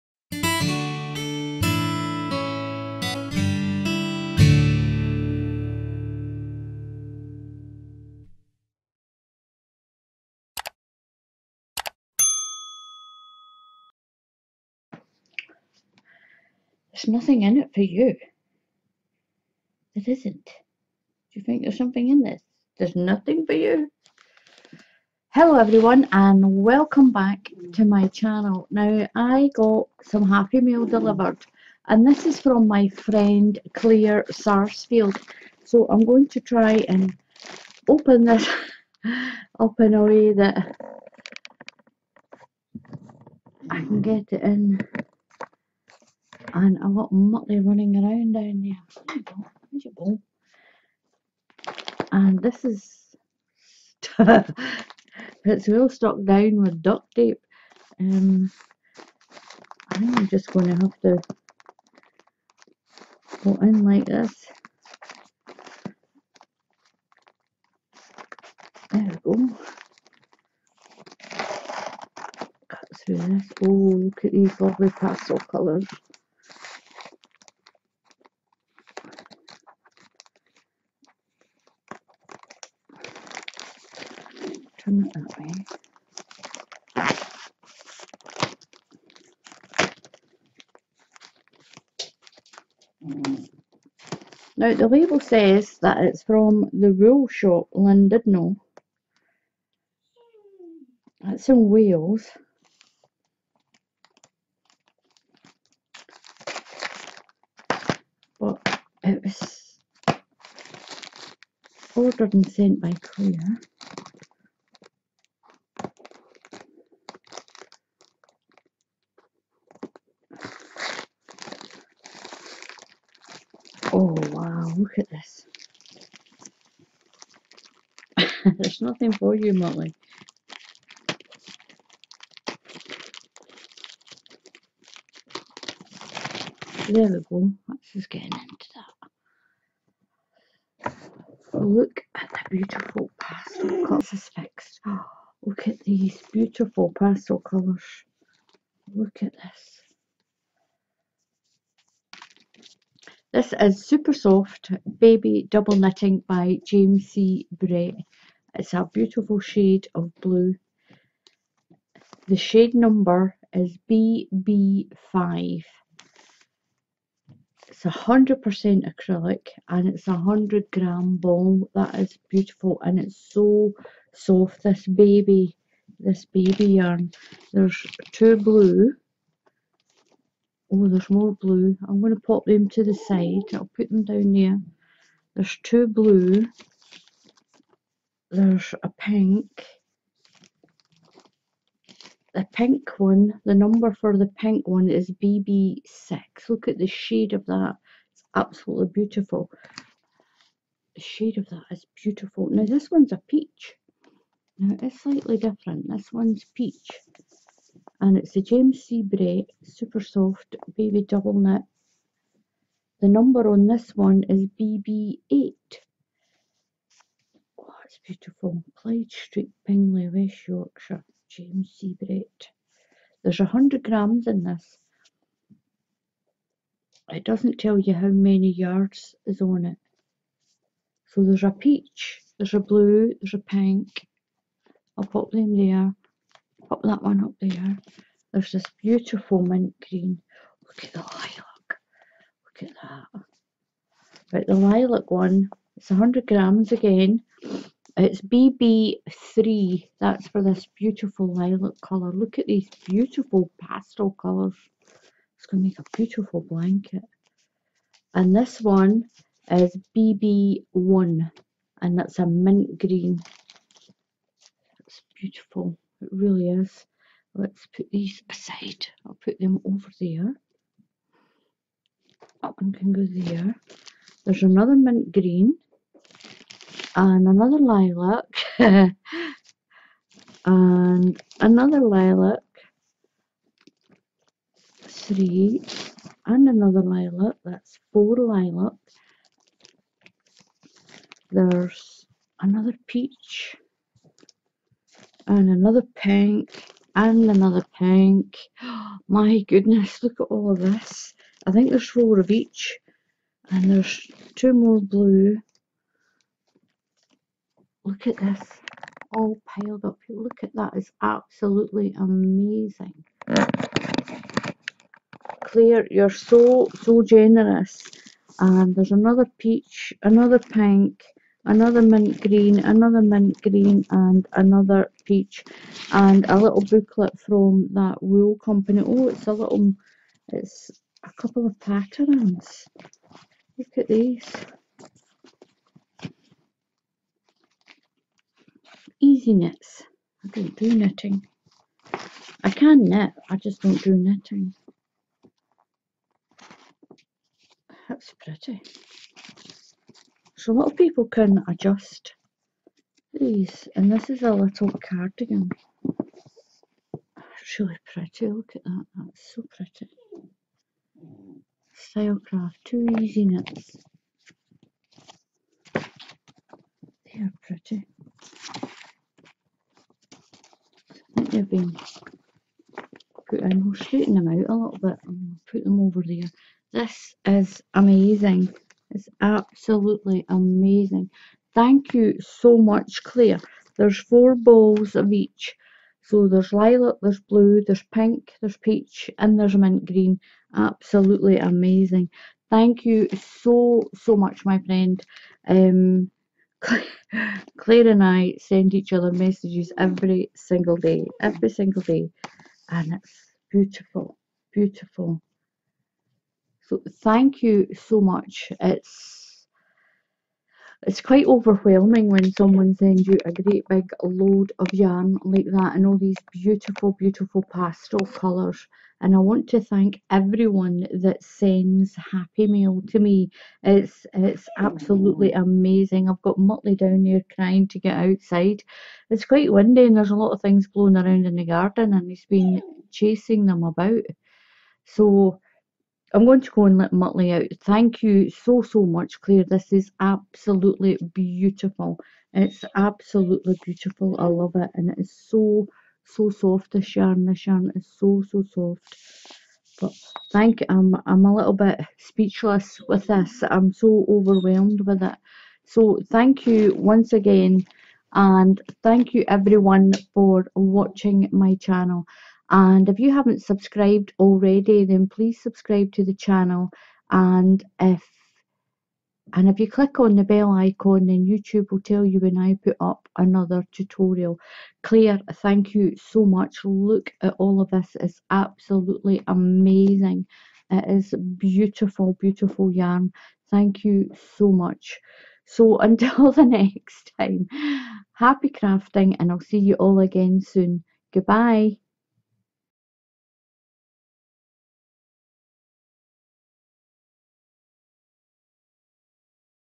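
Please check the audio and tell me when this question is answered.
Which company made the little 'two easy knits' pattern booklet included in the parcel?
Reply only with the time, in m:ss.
6:01.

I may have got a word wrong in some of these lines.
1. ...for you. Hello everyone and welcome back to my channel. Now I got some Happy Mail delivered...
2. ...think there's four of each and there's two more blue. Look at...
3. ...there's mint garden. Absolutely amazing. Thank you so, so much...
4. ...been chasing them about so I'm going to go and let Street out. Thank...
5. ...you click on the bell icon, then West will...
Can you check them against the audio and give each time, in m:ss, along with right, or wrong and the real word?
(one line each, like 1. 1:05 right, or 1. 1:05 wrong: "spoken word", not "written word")
1. 0:23 right
2. 5:01 right
3. 6:29 wrong: "green", not "garden"
4. 7:12 wrong: "Muttley", not "Street"
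5. 7:49 wrong: "YouTube", not "West".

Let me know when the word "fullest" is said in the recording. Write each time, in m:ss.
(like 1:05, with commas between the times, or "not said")
not said.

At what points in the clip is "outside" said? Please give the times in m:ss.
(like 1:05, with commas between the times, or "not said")
7:07.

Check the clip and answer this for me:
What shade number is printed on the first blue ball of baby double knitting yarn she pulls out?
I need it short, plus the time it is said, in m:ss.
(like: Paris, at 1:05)
BB5, at 2:43.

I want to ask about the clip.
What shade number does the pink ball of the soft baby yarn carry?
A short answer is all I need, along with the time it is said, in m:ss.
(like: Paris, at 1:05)
BB6, at 3:15.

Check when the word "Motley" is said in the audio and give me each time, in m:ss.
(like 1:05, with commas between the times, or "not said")
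0:47, 7:06.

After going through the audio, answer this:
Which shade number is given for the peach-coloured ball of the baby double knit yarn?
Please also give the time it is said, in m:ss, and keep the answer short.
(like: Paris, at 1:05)
BB8, at 3:34.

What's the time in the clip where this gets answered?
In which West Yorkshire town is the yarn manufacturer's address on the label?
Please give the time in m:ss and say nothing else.
3:39.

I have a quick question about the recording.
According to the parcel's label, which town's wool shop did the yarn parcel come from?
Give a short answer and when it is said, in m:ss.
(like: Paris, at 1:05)
Llandudno, at 1:37.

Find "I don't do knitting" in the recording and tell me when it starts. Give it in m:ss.
5:40.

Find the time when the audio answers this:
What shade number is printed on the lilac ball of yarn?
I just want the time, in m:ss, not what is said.
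4:08.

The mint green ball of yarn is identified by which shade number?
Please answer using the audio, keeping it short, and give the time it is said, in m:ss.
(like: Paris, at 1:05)
BB1, at 4:19.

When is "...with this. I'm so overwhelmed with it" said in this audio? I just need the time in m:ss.
7:32.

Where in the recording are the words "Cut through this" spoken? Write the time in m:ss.
1:12.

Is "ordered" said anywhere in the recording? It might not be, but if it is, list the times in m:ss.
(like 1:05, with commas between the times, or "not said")
1:51.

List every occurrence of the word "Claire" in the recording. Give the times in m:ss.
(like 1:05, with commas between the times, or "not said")
0:33, 1:53, 5:15, 6:23, 6:37, 7:19, 7:54.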